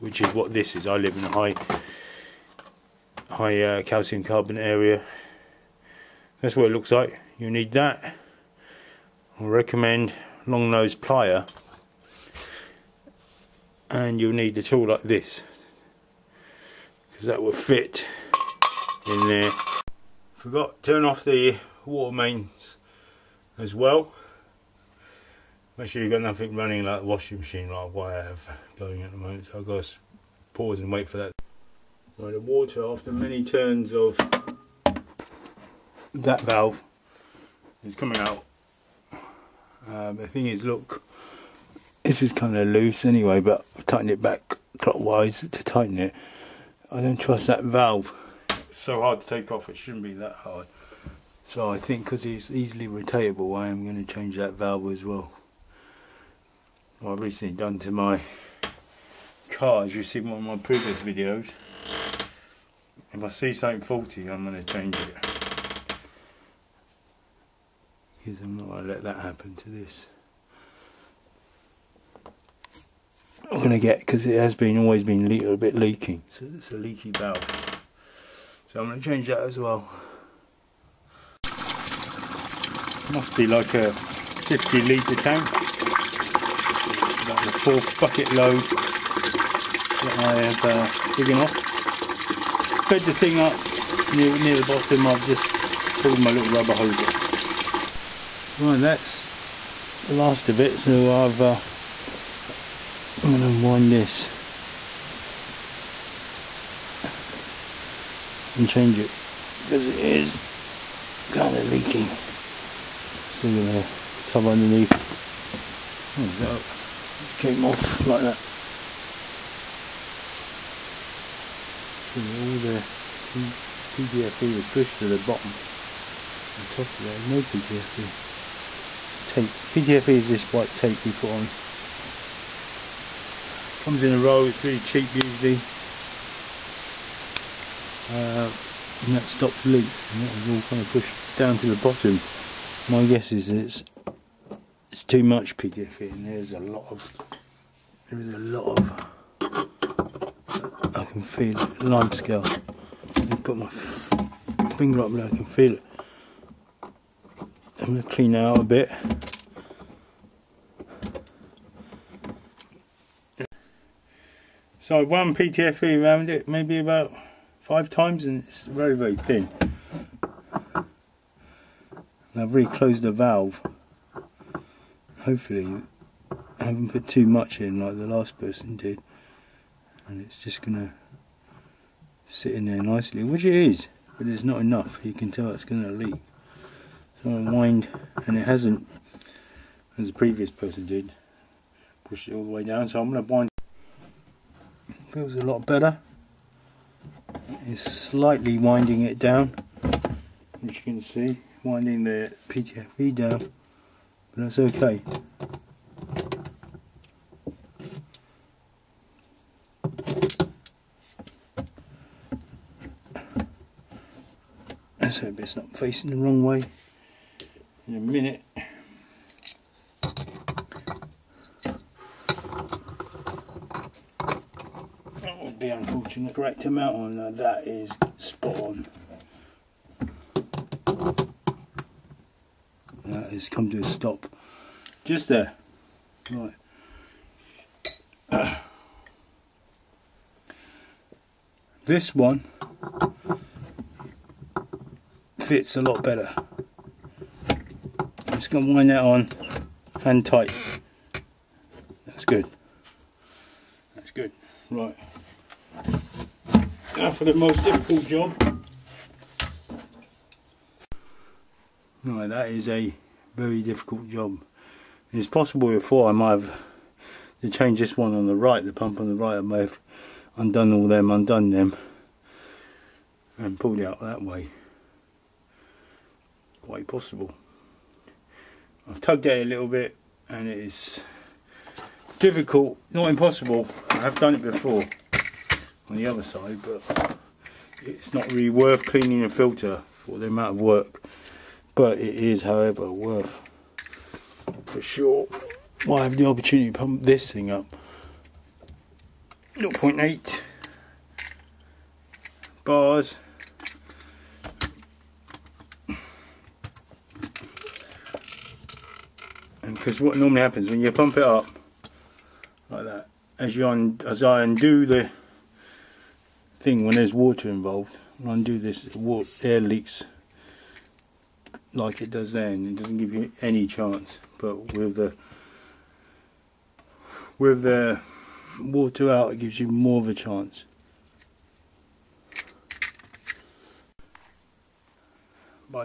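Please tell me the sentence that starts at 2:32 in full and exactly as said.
I can put my finger up there, I can feel it.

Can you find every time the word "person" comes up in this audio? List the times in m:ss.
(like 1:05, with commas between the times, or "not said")
2:58, 3:10.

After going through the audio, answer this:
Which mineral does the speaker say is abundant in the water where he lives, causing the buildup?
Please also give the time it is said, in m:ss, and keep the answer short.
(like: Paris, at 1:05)
Calcium carbonate, at 0:03.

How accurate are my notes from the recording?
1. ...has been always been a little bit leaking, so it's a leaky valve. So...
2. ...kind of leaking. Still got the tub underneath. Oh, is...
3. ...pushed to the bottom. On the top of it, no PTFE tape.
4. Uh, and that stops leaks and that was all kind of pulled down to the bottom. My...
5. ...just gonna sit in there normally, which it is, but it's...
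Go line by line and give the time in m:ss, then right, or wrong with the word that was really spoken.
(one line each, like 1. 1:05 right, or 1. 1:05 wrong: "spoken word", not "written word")
1. 1:14 right
2. 1:51 right
3. 2:04 right
4. 2:18 wrong: "pushed", not "pulled"
5. 3:00 wrong: "nicely", not "normally".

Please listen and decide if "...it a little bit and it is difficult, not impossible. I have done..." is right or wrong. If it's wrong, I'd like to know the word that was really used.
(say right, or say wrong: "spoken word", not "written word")
right.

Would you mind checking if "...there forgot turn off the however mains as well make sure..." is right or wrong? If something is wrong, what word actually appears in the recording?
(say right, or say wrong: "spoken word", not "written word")
wrong: "water", not "however".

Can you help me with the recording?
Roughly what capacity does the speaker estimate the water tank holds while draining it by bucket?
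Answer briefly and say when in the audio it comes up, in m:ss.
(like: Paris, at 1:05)
50 litres, at 1:23.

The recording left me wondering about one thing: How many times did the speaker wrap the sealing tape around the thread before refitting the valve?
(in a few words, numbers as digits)
5.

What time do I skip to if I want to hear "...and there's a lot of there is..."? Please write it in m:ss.
2:26.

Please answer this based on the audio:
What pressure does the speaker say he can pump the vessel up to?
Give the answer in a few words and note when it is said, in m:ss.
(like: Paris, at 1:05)
0.8 bars, at 4:59.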